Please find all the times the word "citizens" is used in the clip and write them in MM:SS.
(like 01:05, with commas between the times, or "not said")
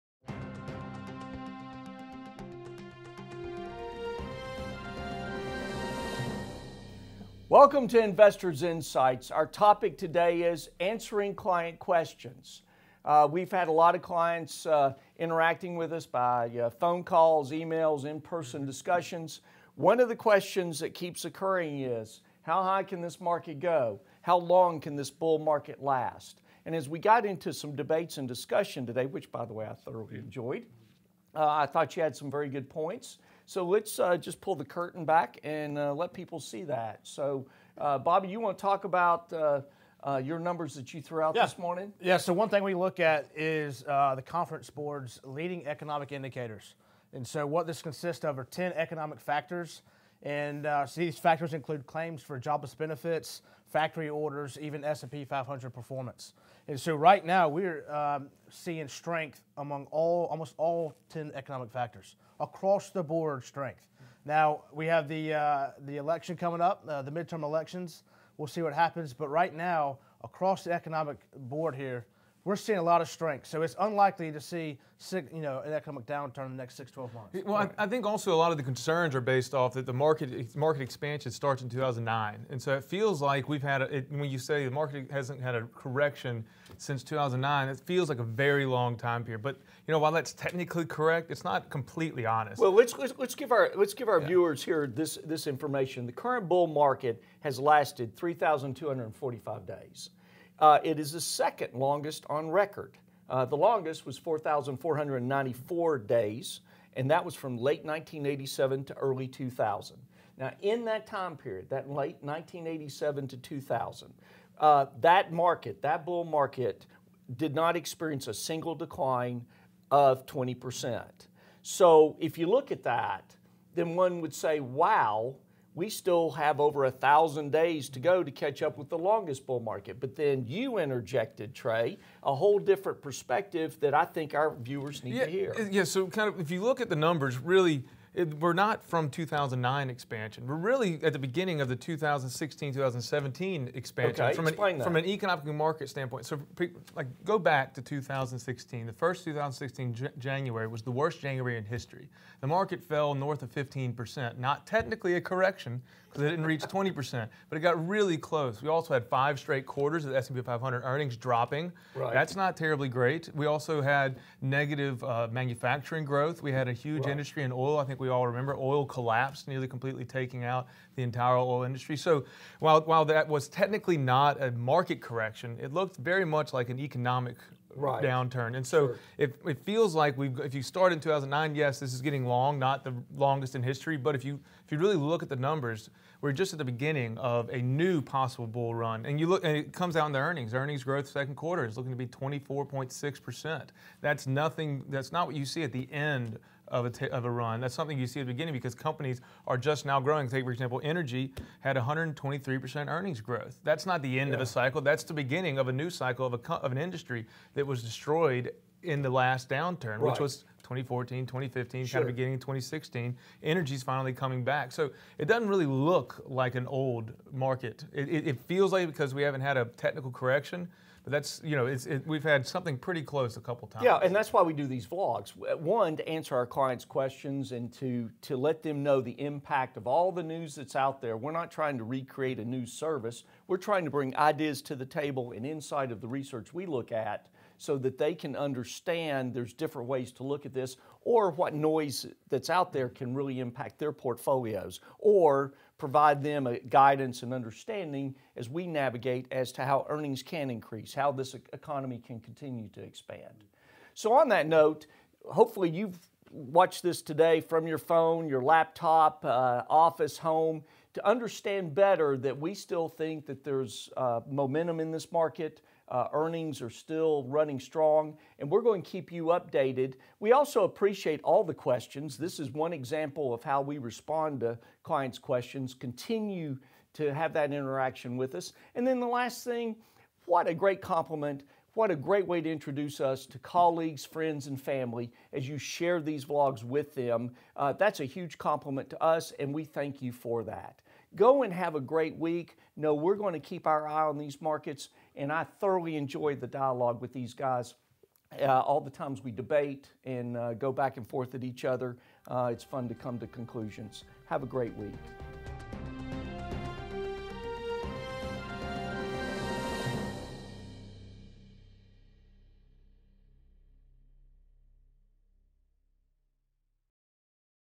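not said.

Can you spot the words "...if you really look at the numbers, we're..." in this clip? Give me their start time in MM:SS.
03:04.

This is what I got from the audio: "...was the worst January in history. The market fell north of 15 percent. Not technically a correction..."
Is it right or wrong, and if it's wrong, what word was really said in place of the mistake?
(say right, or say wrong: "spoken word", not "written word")
right.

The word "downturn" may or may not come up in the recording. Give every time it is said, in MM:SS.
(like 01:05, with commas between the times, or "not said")
01:16, 02:58, 03:29.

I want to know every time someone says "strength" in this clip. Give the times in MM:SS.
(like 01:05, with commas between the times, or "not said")
00:58, 01:03, 01:13.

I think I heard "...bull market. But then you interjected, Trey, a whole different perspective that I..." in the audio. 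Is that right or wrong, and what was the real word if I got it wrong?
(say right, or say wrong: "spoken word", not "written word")
right.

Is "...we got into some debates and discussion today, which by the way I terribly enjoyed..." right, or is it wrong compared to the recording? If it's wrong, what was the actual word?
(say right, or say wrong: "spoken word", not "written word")
wrong: "thoroughly", not "terribly".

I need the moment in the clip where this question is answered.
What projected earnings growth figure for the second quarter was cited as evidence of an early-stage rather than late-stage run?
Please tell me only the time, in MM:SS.
03:12.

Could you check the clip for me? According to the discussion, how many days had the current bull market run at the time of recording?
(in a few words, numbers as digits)
3,245 days.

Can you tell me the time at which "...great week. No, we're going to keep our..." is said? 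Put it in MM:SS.
04:51.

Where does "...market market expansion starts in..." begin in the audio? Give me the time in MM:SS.
01:19.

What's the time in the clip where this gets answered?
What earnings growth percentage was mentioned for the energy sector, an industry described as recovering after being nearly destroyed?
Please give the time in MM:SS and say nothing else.
03:21.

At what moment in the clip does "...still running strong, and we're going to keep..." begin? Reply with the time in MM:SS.
04:26.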